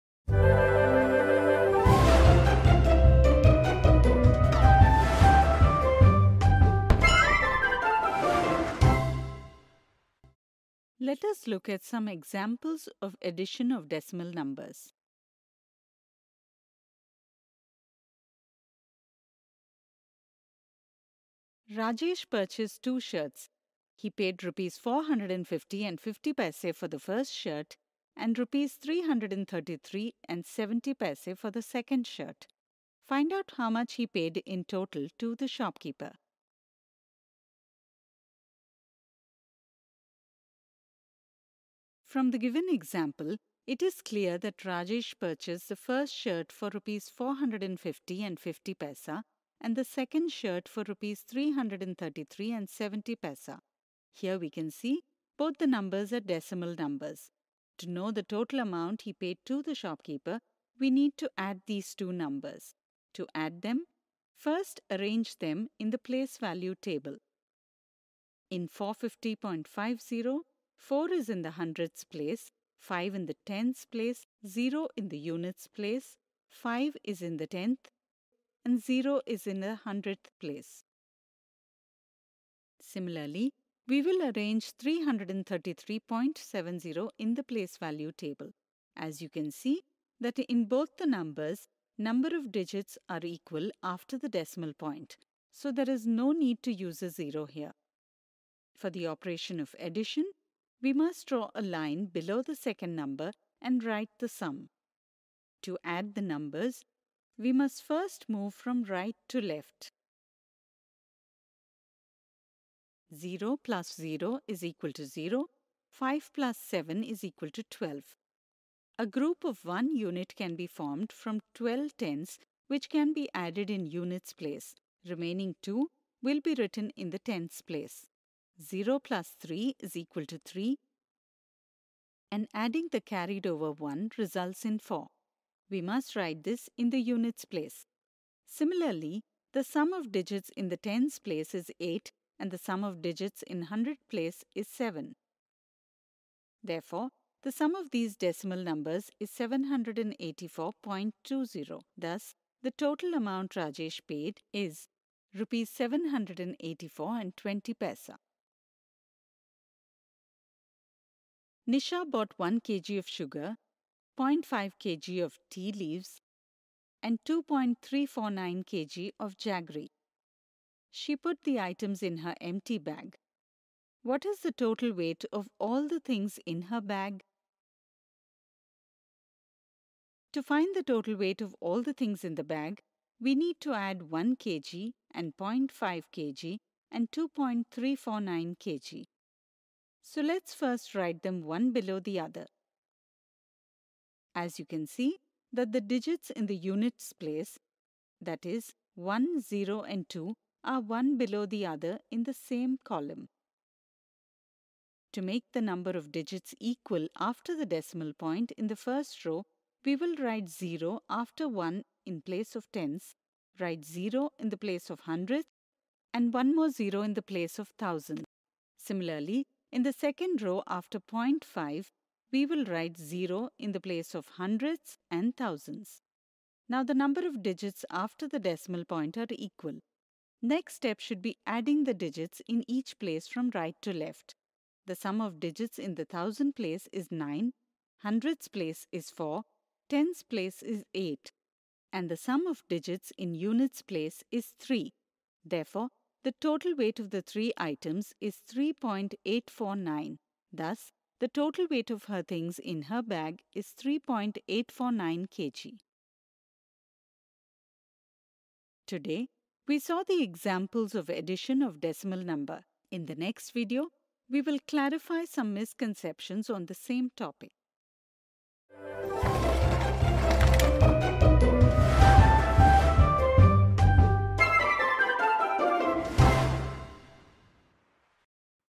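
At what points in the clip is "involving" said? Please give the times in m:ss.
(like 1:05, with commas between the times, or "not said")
not said.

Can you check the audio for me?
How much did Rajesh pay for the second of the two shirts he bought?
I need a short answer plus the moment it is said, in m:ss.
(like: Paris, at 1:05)
Rs 333.70, at 0:28.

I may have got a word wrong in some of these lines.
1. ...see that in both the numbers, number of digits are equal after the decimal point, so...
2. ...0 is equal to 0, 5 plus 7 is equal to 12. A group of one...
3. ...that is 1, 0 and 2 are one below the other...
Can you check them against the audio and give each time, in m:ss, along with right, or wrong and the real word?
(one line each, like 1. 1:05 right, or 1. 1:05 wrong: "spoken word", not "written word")
1. 1:29 right
2. 1:53 right
3. 3:18 right.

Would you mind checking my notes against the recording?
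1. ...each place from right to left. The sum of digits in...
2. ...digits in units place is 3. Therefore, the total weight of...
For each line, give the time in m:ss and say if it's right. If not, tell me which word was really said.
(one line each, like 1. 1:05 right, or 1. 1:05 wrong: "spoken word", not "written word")
1. 3:52 right
2. 4:02 right.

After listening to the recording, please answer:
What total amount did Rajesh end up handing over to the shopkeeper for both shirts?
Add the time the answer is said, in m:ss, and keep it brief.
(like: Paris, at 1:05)
Rs 784.20, at 2:35.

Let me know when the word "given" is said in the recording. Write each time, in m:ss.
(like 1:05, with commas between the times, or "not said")
0:42.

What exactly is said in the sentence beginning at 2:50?
She put the items in her empty bag.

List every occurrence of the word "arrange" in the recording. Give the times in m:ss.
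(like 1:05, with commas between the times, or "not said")
1:04, 1:24.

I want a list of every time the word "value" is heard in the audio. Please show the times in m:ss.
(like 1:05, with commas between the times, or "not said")
1:06, 1:27.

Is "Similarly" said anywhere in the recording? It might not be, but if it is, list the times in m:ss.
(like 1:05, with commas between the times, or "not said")
1:22, 2:18, 3:38.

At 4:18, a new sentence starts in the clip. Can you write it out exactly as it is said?
Today, we saw the examples of addition of decimal number.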